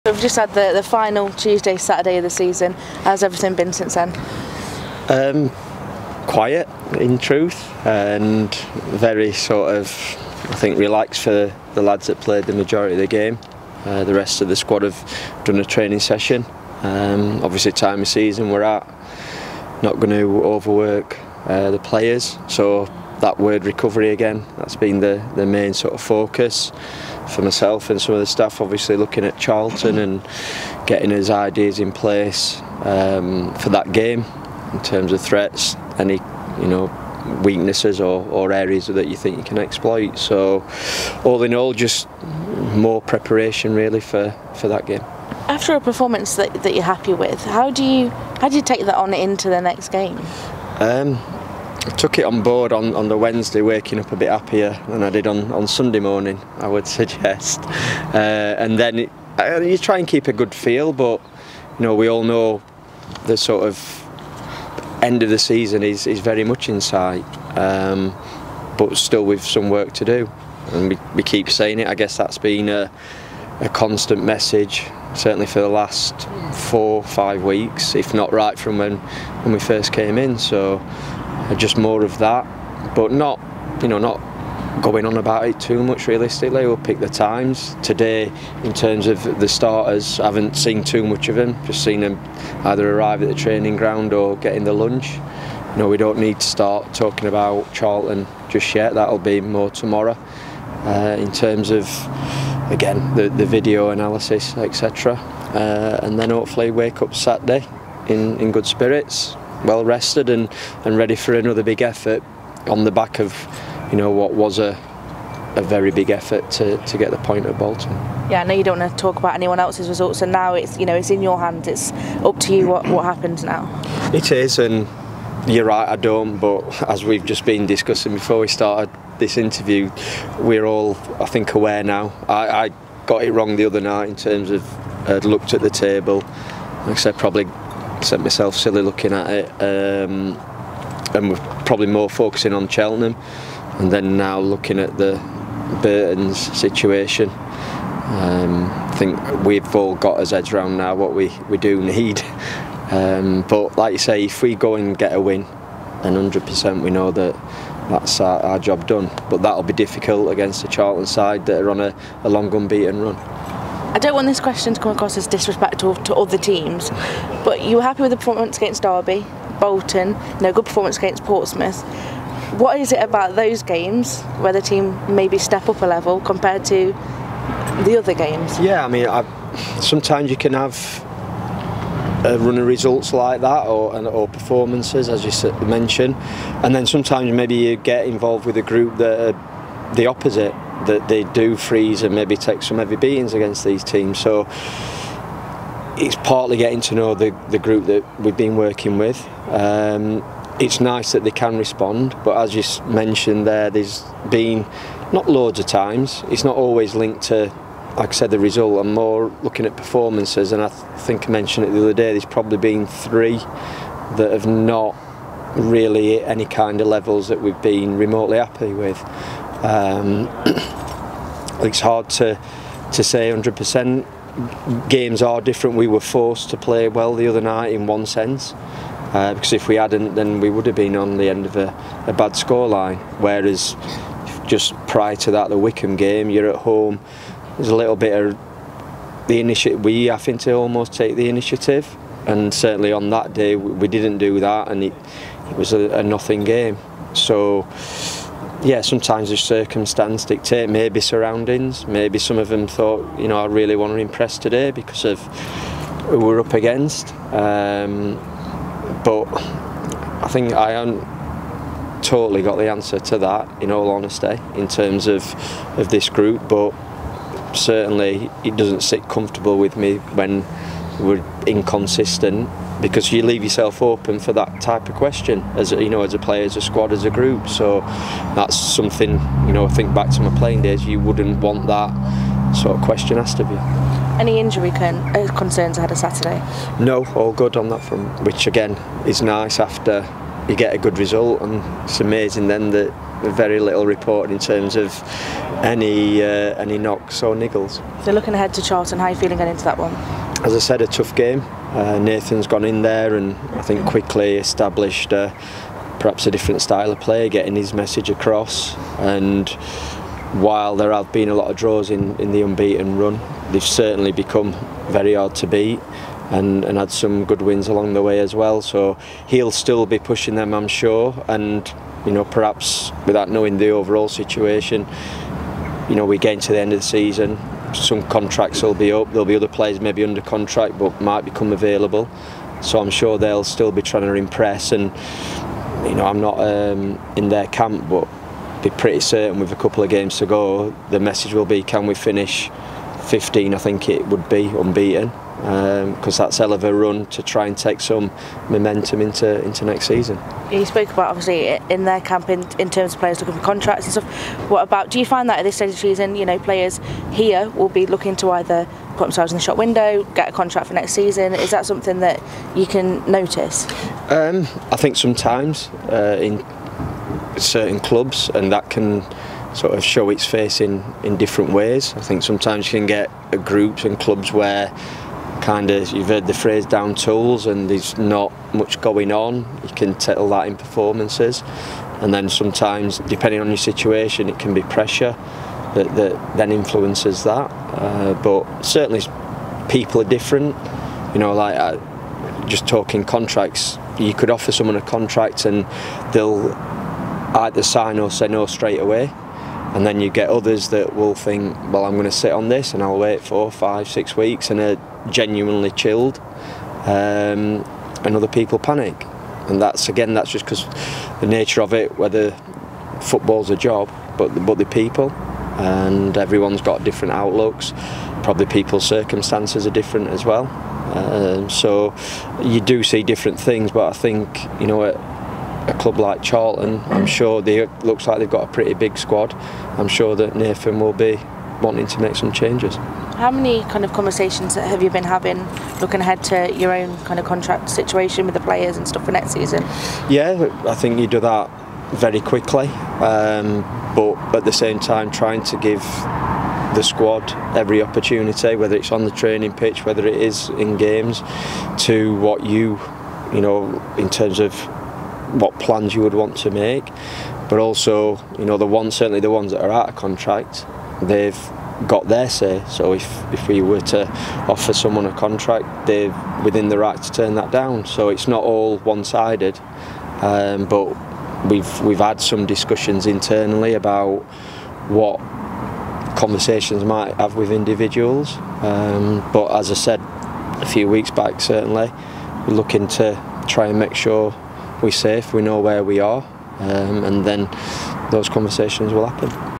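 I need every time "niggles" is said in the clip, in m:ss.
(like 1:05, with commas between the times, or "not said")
4:57.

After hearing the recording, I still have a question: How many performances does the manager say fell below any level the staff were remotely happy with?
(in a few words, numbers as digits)
3.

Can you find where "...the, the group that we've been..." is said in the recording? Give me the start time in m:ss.
3:17.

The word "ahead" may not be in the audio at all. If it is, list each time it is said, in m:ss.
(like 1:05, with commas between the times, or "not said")
4:45, 4:58, 7:16.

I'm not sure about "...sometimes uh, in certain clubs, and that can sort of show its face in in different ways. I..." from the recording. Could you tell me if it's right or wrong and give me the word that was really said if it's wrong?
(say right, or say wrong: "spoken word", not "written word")
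right.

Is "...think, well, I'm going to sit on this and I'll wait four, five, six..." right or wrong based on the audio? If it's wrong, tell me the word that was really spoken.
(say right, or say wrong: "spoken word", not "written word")
right.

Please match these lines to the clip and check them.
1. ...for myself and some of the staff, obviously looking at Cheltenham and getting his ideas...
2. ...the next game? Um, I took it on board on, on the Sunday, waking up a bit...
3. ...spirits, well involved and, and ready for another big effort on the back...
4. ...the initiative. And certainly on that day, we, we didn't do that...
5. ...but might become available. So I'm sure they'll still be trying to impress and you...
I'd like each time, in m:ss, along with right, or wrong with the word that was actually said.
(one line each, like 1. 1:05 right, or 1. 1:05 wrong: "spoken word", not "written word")
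1. 0:27 wrong: "Charlton", not "Cheltenham"
2. 0:49 wrong: "Wednesday", not "Sunday"
3. 1:48 wrong: "rested", not "involved"
4. 4:01 right
5. 5:30 right.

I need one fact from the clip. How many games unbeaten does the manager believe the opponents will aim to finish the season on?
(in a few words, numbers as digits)
15.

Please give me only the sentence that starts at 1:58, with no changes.
Yeah, I know you don't want to talk about anyone else's results, and now it's you know it's in your hands.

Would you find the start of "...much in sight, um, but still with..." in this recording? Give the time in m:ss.
1:06.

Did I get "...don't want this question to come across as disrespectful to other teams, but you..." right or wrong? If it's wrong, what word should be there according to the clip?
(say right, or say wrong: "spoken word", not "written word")
right.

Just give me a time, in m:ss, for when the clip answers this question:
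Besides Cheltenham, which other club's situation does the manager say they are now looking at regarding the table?
2:25.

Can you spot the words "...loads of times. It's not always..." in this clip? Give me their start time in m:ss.
3:25.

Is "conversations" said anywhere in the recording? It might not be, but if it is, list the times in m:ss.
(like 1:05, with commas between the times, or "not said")
7:13, 7:56, 8:08.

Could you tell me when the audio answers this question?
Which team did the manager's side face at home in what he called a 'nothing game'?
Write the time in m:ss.
3:55.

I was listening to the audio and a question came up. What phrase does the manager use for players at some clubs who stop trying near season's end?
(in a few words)
down tools.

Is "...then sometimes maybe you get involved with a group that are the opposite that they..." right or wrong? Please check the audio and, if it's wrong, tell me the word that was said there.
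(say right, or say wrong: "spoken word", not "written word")
right.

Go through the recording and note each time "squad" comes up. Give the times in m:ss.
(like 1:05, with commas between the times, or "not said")
0:14, 4:36, 7:08, 7:26.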